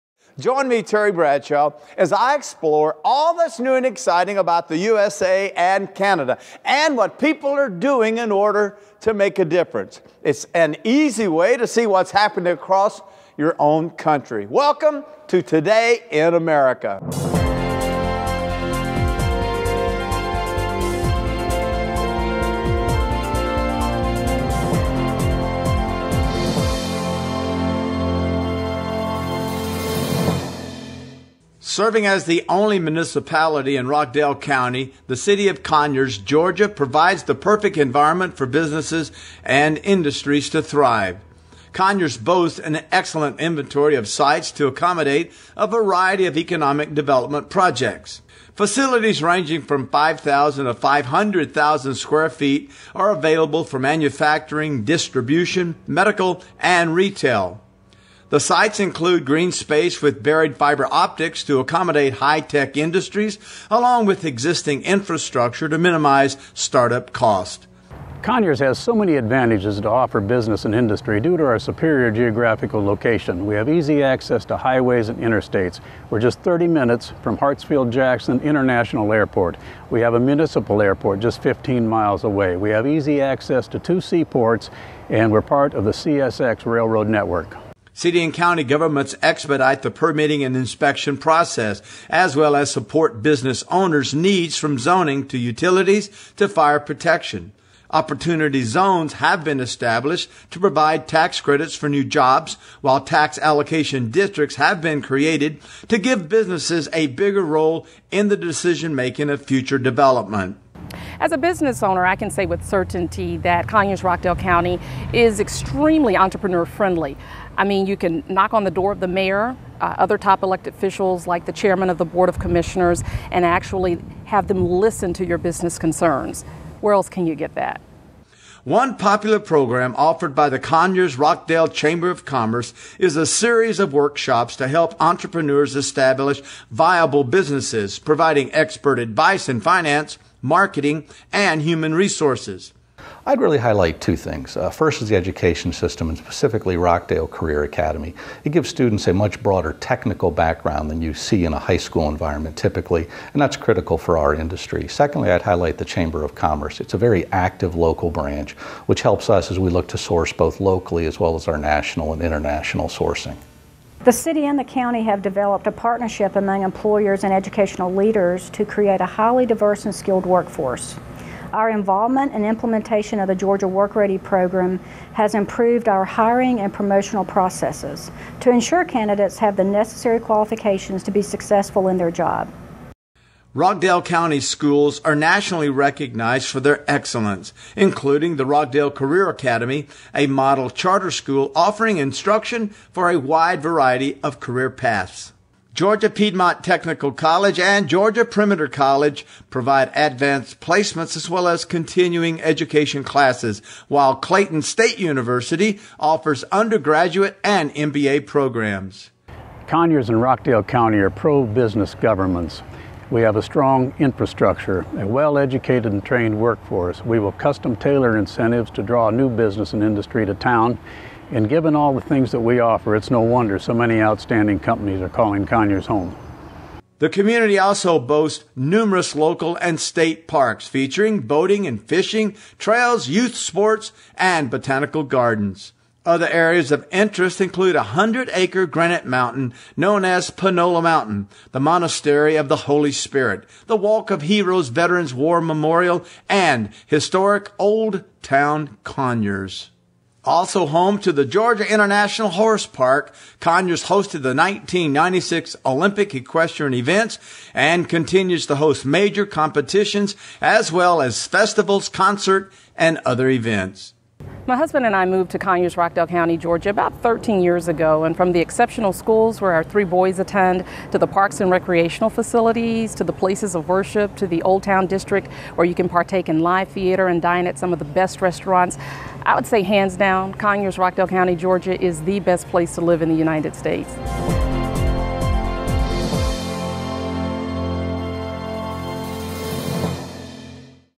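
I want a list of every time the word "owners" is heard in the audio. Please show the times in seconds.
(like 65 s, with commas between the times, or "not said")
93 s, 111 s.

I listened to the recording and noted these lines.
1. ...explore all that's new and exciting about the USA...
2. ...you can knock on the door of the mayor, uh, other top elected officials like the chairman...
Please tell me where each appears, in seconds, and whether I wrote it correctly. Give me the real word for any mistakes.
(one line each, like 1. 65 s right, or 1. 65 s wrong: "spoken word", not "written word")
1. 2 s right
2. 117 s right.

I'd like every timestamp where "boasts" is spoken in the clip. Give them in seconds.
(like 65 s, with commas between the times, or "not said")
42 s, 227 s.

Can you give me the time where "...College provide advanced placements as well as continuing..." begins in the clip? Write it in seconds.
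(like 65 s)
198 s.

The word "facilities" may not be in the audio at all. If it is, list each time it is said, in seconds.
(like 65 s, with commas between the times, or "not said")
48 s, 272 s.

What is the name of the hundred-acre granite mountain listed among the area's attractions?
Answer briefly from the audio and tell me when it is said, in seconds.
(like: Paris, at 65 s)
Panola Mountain, at 240 s.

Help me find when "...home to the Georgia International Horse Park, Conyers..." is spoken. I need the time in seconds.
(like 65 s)
250 s.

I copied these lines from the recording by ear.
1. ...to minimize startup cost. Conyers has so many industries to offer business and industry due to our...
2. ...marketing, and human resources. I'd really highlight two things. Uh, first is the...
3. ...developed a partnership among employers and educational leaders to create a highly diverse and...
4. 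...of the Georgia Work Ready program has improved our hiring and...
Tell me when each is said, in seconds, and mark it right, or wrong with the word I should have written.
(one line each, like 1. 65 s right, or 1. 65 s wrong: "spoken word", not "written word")
1. 65 s wrong: "advantages", not "industries"
2. 140 s right
3. 165 s right
4. 173 s right.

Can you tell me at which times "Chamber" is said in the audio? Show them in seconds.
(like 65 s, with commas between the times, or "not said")
131 s, 155 s.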